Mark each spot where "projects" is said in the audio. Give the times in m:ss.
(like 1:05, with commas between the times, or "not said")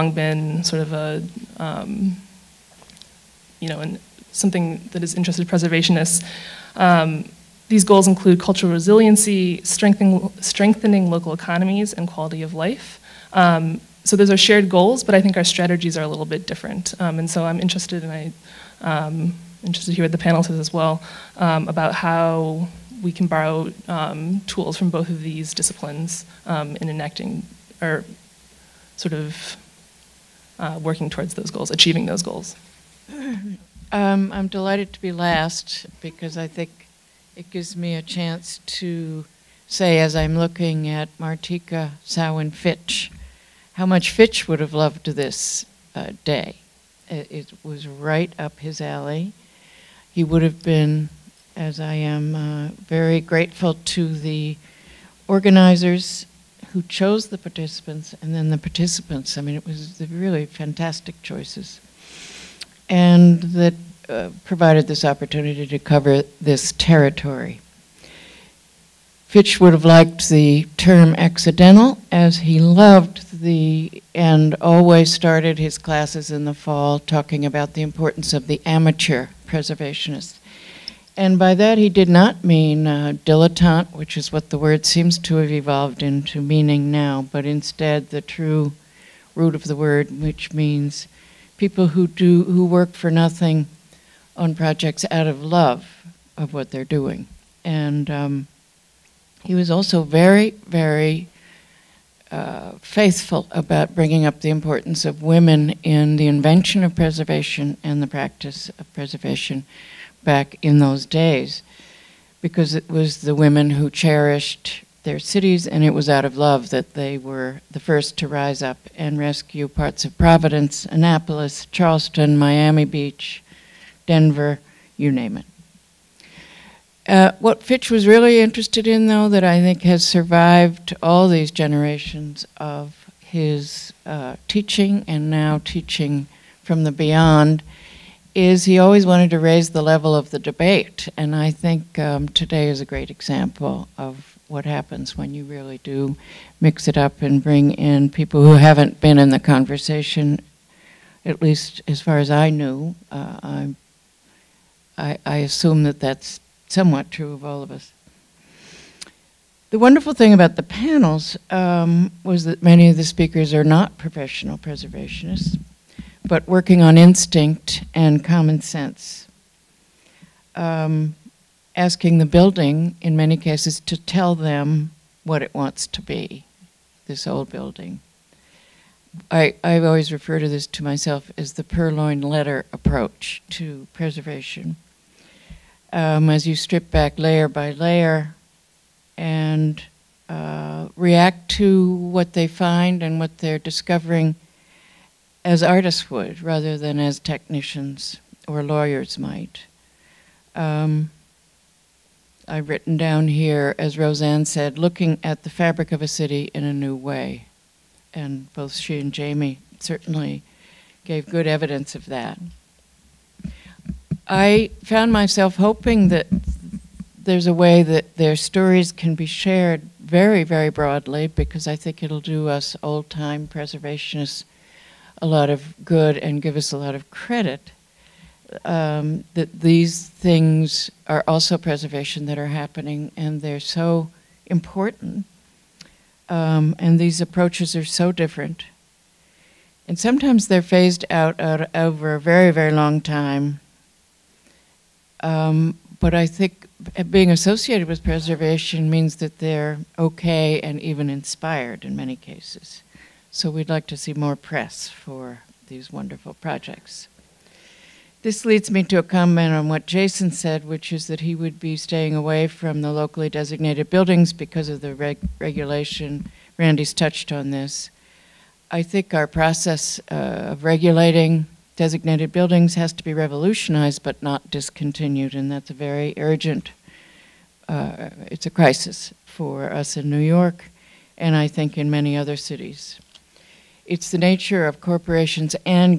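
1:34, 4:16.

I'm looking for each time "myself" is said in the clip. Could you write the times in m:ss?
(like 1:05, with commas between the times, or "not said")
3:00, 3:35.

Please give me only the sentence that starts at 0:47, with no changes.
It, it, was right up his alley.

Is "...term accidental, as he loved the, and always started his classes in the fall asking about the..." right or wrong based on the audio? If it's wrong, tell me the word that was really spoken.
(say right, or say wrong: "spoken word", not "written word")
wrong: "talking", not "asking".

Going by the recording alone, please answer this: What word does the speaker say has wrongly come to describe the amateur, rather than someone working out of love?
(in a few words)
dilettante.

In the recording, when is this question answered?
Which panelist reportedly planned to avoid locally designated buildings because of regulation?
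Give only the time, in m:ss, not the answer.
4:19.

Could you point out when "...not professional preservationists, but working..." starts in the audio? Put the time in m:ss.
2:43.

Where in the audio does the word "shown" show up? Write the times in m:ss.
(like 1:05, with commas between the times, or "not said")
not said.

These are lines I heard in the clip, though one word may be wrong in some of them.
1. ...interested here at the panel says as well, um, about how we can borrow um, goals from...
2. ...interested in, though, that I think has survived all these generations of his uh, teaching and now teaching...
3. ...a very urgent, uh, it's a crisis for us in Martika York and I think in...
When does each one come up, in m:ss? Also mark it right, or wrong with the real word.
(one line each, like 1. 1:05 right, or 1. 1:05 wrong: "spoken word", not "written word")
1. 0:19 wrong: "tools", not "goals"
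2. 2:08 right
3. 4:35 wrong: "New", not "Martika".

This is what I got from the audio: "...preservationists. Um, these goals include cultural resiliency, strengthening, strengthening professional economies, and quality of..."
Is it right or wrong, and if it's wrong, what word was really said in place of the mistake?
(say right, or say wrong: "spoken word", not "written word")
wrong: "local", not "professional".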